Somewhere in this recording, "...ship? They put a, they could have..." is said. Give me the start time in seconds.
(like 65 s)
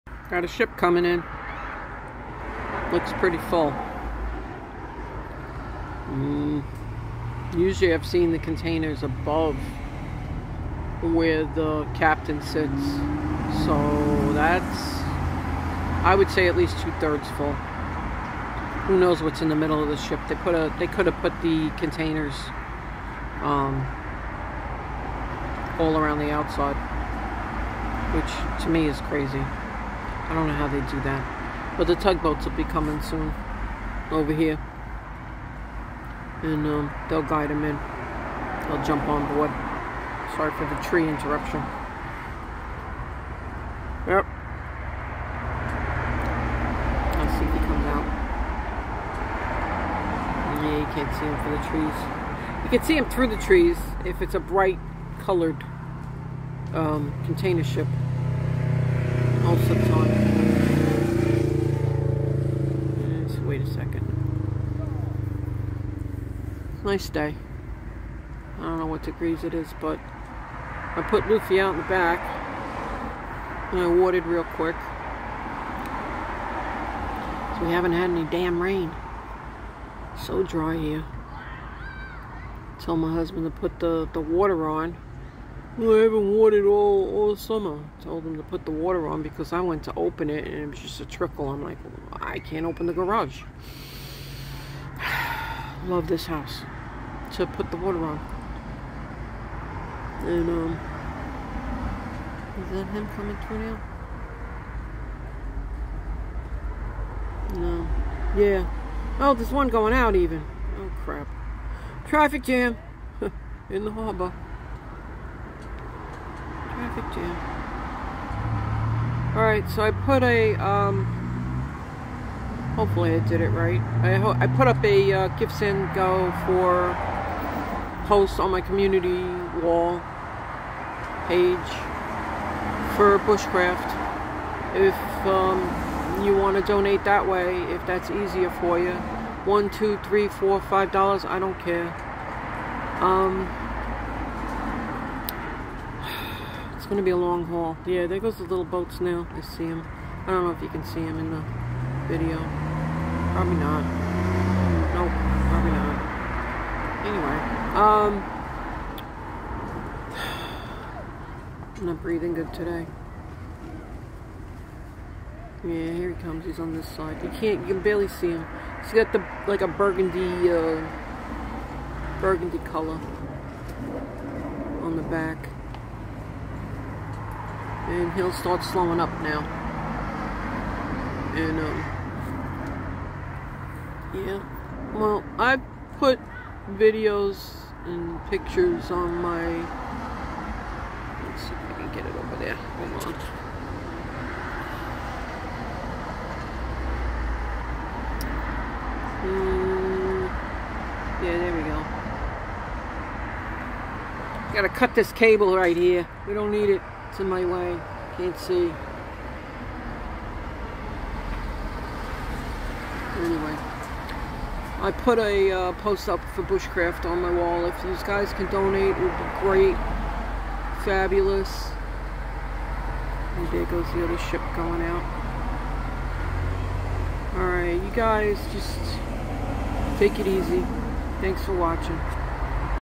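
19 s.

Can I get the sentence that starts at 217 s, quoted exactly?
If these guys can donate, it would be great.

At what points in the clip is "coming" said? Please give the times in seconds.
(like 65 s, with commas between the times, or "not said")
0 s, 32 s, 103 s.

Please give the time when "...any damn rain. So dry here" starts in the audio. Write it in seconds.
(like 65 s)
78 s.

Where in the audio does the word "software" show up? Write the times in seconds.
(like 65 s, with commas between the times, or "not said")
not said.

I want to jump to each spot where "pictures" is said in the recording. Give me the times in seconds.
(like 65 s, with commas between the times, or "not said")
188 s.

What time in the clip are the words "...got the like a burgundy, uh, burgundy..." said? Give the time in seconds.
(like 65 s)
168 s.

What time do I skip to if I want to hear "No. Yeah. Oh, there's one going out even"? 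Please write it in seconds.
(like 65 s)
107 s.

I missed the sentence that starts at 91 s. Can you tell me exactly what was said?
I'm like, I can't open the garage love this house to put the water on.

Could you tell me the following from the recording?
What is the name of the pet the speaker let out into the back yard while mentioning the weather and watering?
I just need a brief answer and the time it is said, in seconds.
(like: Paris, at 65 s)
Luffy, at 71 s.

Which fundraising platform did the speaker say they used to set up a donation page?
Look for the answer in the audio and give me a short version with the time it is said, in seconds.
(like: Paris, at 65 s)
GiveSendGo, at 125 s.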